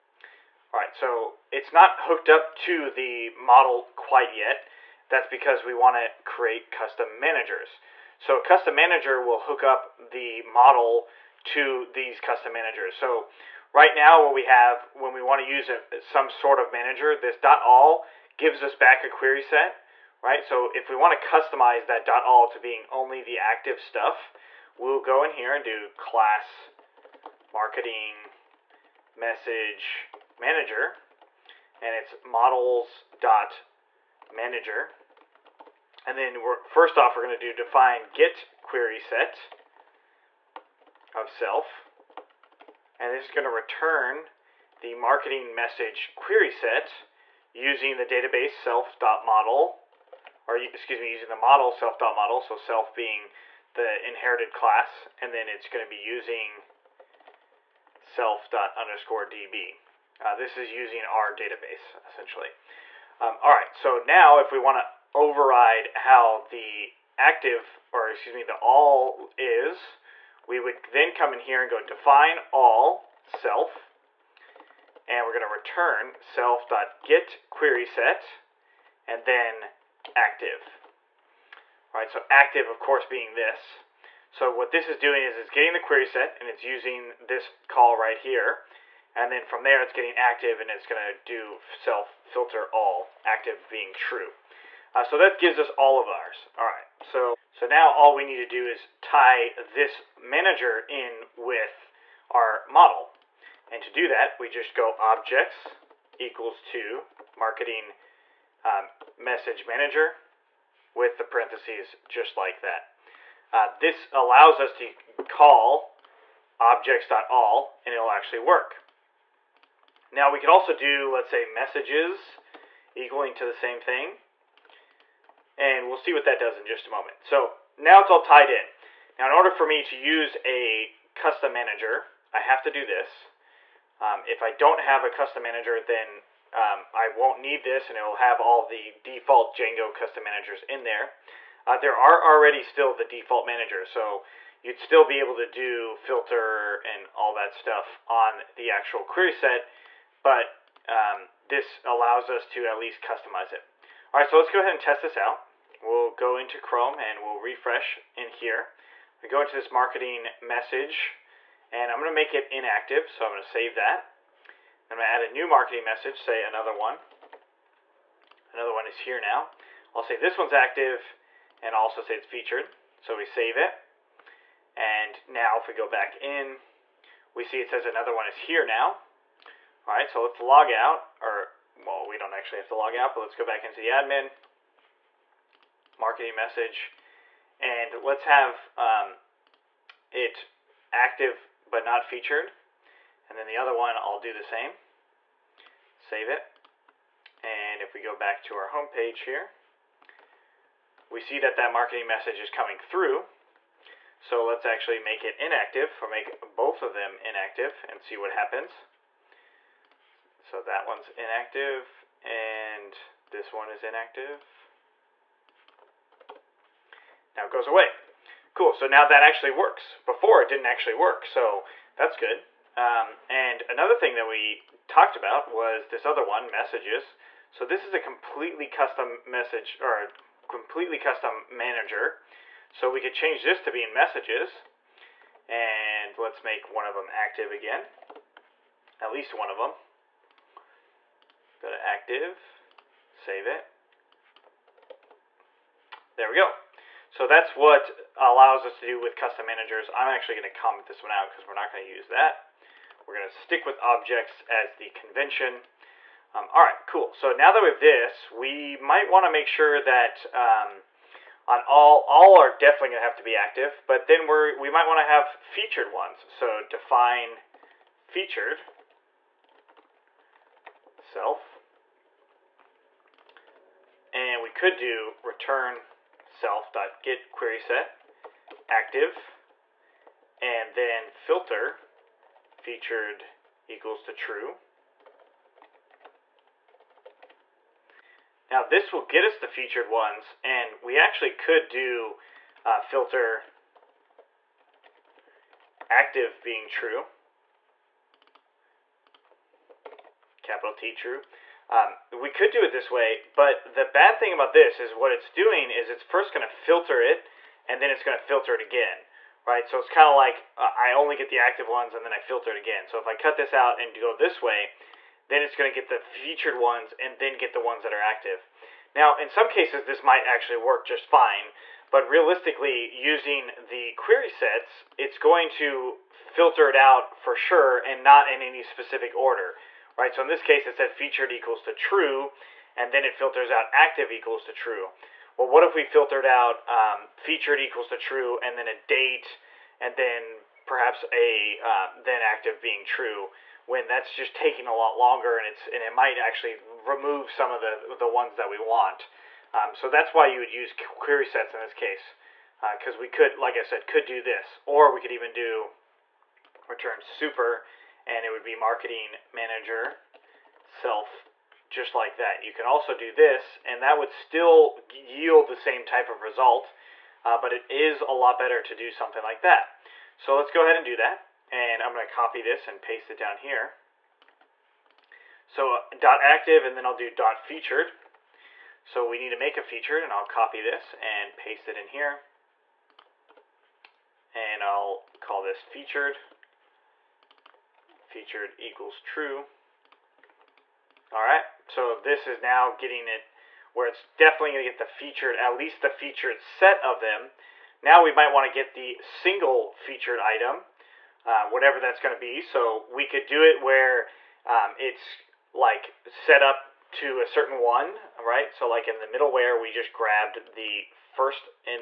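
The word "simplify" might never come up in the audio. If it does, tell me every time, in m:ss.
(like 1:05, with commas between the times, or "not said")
not said.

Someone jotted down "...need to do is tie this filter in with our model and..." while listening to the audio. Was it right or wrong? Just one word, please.
wrong.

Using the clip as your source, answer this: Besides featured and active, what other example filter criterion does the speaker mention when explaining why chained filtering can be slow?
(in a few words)
a date.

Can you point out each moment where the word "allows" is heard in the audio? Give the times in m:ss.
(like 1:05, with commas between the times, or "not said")
1:54, 2:31, 4:08.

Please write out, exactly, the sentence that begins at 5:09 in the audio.
So it's kind of like uh, I only get the active ones, and then I filter it again.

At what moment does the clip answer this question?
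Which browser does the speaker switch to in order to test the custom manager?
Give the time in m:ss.
2:36.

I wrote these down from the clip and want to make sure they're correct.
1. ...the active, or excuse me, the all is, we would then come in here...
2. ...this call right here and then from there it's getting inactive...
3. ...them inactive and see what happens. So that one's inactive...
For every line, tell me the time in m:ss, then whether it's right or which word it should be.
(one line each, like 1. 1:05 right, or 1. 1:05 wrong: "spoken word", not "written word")
1. 1:06 right
2. 1:27 wrong: "active", not "inactive"
3. 3:26 right.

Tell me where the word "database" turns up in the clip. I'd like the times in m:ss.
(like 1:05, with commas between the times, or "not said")
0:48, 1:01.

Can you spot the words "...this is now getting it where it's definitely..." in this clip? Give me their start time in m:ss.
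6:31.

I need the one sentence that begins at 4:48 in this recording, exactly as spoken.
Now this will get us the featured ones and we actually could do uh, filter active being true.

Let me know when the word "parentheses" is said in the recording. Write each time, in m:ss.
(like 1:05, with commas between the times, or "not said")
1:51.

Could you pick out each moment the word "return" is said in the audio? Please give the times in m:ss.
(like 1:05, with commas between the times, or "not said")
0:43, 1:15, 4:35, 5:56.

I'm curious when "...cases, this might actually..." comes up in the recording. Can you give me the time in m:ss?
5:19.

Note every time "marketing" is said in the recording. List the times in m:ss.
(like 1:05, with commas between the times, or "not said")
0:27, 0:44, 1:47, 2:39, 2:45, 3:05, 3:21, 5:58.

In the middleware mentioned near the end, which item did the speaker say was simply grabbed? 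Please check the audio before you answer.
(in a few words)
the first.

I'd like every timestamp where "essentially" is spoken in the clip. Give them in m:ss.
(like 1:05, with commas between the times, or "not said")
1:02.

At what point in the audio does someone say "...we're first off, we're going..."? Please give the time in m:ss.
0:36.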